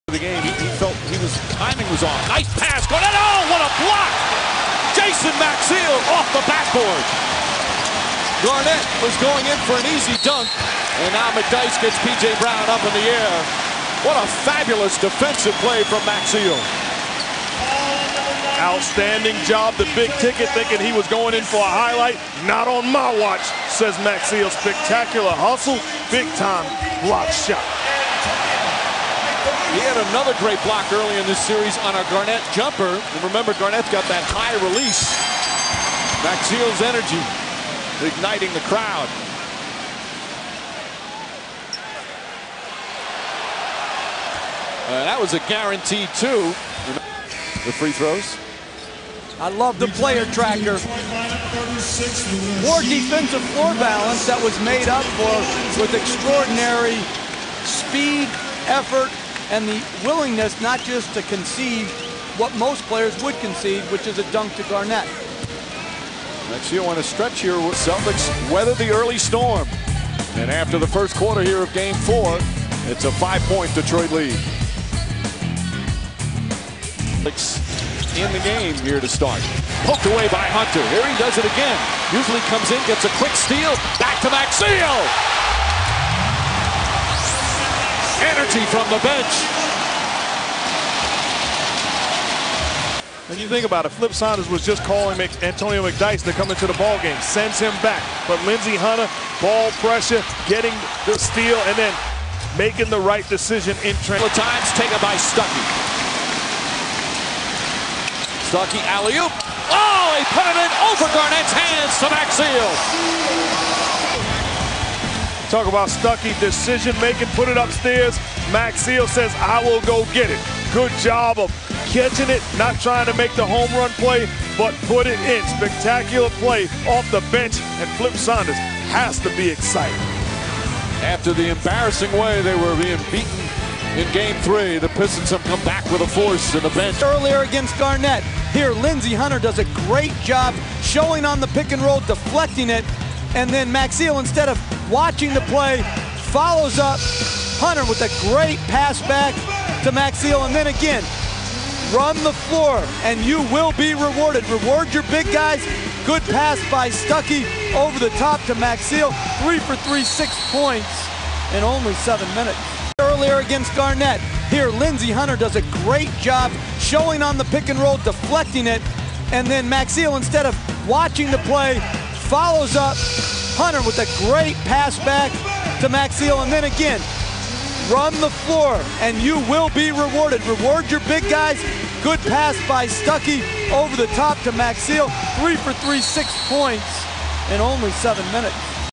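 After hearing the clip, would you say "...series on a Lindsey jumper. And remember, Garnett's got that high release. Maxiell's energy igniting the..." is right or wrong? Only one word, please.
wrong.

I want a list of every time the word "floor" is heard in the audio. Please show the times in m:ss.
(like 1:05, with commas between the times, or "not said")
0:53, 2:32, 2:58.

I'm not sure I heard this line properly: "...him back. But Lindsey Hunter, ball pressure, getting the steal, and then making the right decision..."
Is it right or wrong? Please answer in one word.
right.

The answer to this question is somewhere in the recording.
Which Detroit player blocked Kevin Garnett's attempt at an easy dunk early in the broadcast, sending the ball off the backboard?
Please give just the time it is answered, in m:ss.
0:04.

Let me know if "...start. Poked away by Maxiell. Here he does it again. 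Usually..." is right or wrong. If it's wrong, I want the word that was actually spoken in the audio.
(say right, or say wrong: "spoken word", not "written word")
wrong: "Hunter", not "Maxiell".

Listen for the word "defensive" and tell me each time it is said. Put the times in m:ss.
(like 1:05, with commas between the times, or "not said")
0:14, 0:52.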